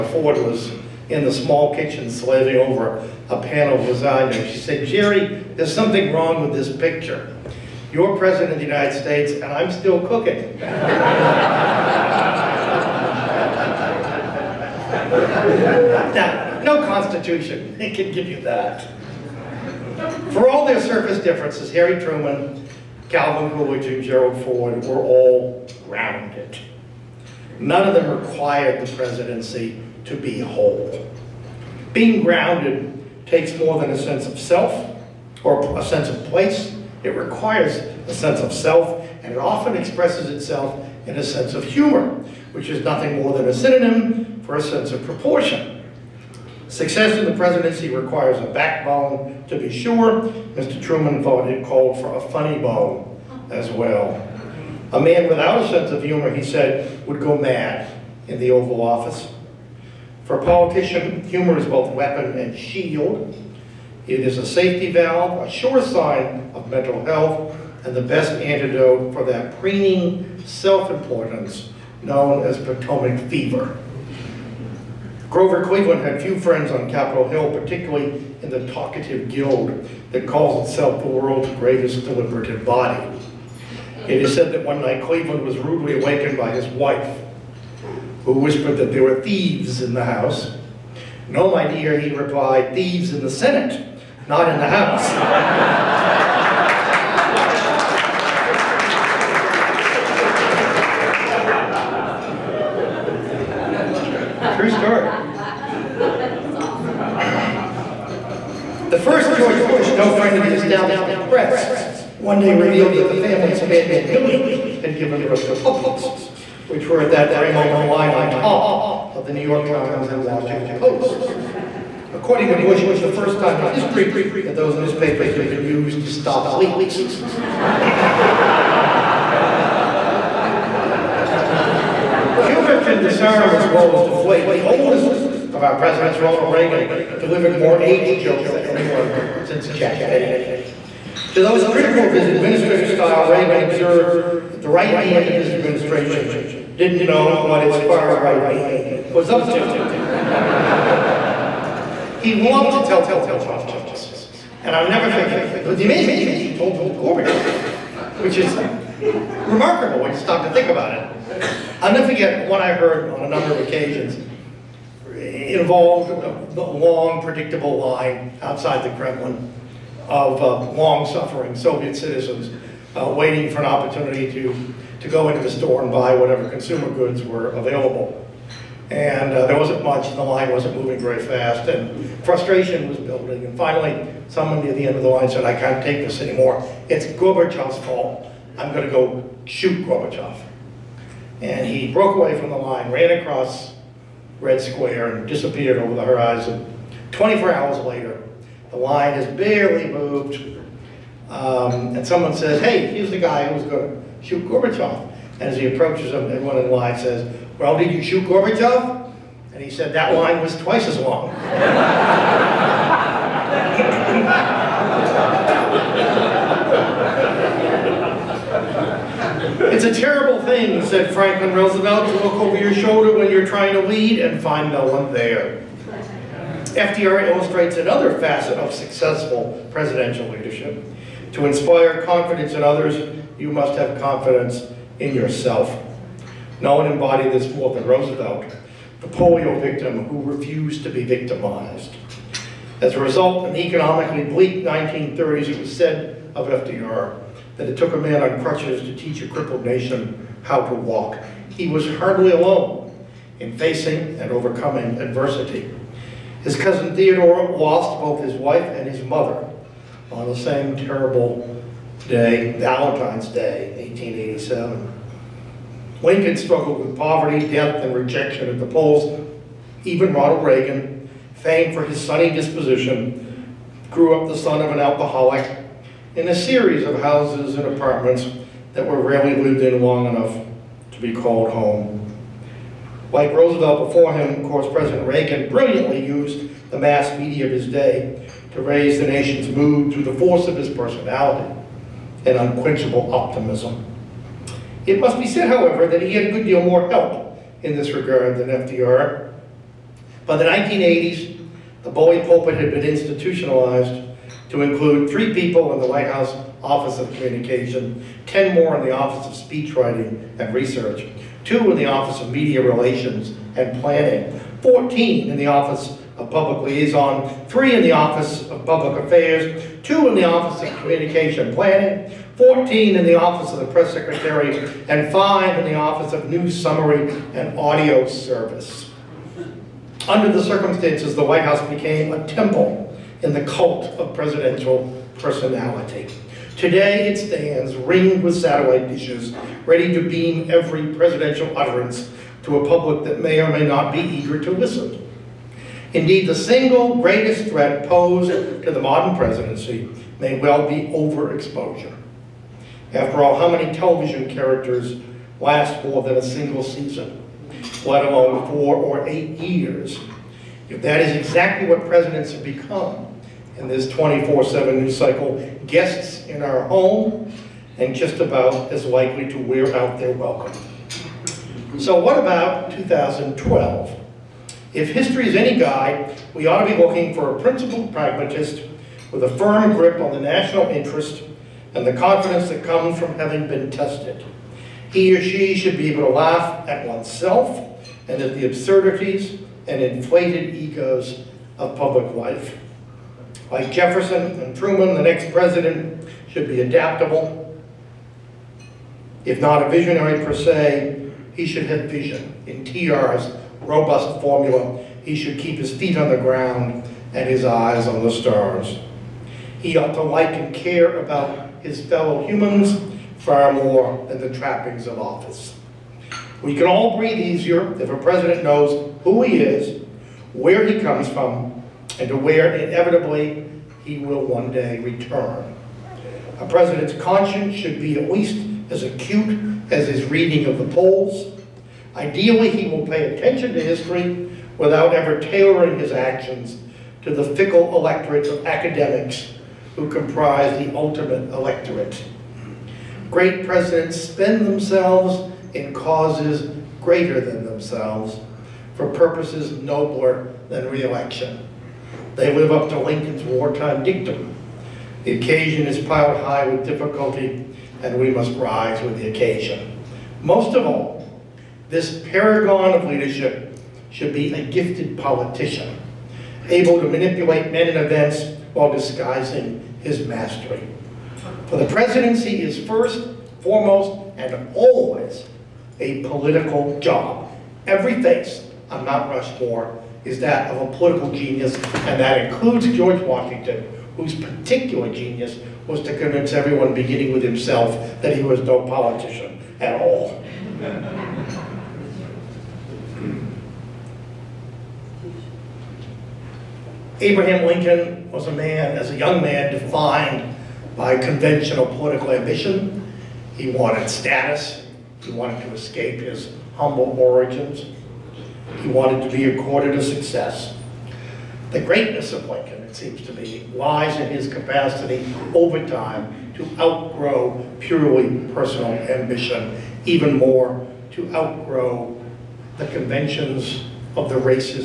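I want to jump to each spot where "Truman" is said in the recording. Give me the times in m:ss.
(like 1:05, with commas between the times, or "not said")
0:22, 0:50, 6:34.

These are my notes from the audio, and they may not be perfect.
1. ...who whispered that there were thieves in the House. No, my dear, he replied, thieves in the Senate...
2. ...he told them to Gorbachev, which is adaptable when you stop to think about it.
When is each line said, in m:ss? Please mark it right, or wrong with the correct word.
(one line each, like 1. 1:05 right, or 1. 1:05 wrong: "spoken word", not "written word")
1. 1:28 right
2. 2:36 wrong: "remarkable", not "adaptable".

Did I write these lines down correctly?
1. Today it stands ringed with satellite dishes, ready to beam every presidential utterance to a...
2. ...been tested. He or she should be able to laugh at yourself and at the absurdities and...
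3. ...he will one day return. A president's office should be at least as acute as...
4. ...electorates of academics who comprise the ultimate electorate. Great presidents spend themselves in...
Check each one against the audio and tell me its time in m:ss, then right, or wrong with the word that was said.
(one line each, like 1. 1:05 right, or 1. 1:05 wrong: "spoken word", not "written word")
1. 5:36 right
2. 6:23 wrong: "oneself", not "yourself"
3. 7:03 wrong: "conscience", not "office"
4. 7:17 right.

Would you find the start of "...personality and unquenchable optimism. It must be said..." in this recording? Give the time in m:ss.
4:50.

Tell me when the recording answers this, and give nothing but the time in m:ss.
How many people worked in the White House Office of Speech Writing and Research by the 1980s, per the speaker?
5:08.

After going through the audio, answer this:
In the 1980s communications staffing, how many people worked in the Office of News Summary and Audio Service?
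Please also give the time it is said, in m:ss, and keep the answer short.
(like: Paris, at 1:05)
5, at 5:25.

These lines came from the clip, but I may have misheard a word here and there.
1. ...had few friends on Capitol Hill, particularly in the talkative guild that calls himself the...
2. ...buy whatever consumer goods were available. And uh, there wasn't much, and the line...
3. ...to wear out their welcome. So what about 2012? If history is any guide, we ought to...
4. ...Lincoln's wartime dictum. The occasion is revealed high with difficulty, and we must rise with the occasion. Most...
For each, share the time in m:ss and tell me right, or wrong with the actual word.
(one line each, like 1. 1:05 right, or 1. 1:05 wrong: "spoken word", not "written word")
1. 1:16 wrong: "itself", not "himself"
2. 2:55 right
3. 6:09 right
4. 7:32 wrong: "piled", not "revealed".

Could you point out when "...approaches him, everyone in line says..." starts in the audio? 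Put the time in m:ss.
3:25.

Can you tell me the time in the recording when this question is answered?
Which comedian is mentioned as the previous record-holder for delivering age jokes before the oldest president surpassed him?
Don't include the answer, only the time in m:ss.
2:19.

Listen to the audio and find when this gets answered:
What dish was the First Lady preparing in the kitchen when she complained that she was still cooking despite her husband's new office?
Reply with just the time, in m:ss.
0:03.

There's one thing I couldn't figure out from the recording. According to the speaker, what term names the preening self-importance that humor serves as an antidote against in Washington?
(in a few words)
Potomac fever.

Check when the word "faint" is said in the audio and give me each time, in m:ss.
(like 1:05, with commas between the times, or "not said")
not said.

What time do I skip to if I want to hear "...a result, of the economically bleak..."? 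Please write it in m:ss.
4:02.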